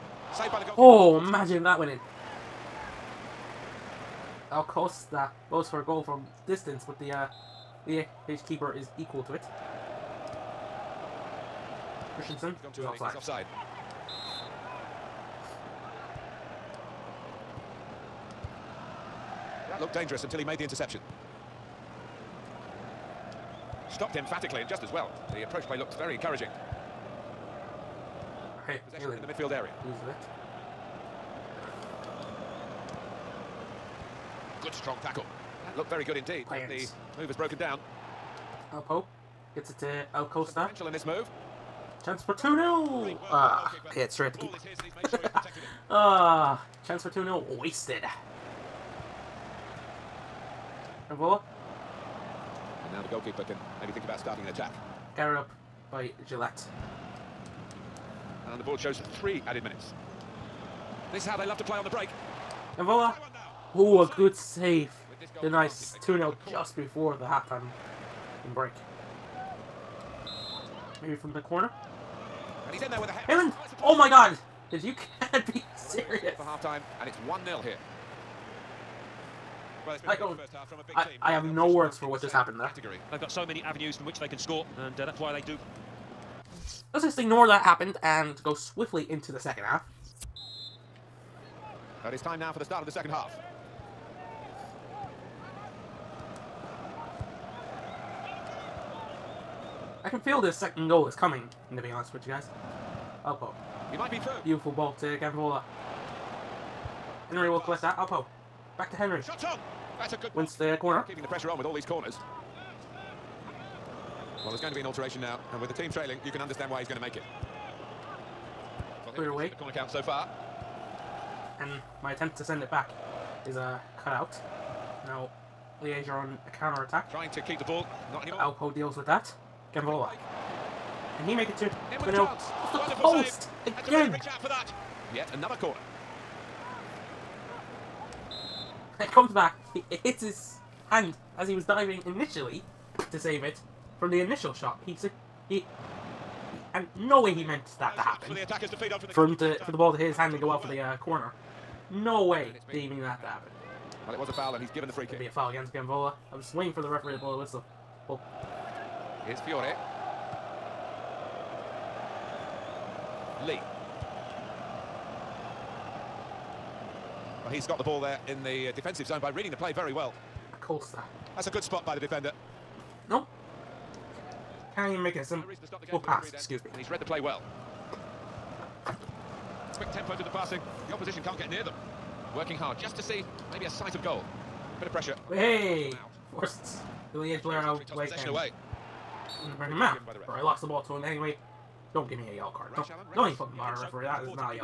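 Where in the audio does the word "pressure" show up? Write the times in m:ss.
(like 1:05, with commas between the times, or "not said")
1:51, 3:04.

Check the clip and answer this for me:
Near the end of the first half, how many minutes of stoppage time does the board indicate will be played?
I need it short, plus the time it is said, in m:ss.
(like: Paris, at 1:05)
3, at 0:59.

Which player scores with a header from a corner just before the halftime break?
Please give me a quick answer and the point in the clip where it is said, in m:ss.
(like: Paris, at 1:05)
Heyland, at 1:13.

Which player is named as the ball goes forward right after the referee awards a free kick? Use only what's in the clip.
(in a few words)
Fiore.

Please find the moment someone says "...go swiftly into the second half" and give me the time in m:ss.
1:28.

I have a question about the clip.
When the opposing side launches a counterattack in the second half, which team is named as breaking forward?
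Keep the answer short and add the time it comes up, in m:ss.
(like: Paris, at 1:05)
Liège, at 2:05.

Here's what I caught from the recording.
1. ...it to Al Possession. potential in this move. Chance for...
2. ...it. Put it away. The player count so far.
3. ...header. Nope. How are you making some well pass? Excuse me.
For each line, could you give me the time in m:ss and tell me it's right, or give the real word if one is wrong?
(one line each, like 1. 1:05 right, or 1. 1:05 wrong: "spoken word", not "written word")
1. 0:39 wrong: "Costa", not "Possession"
2. 1:57 wrong: "corner", not "player"
3. 2:51 wrong: "defender", not "header".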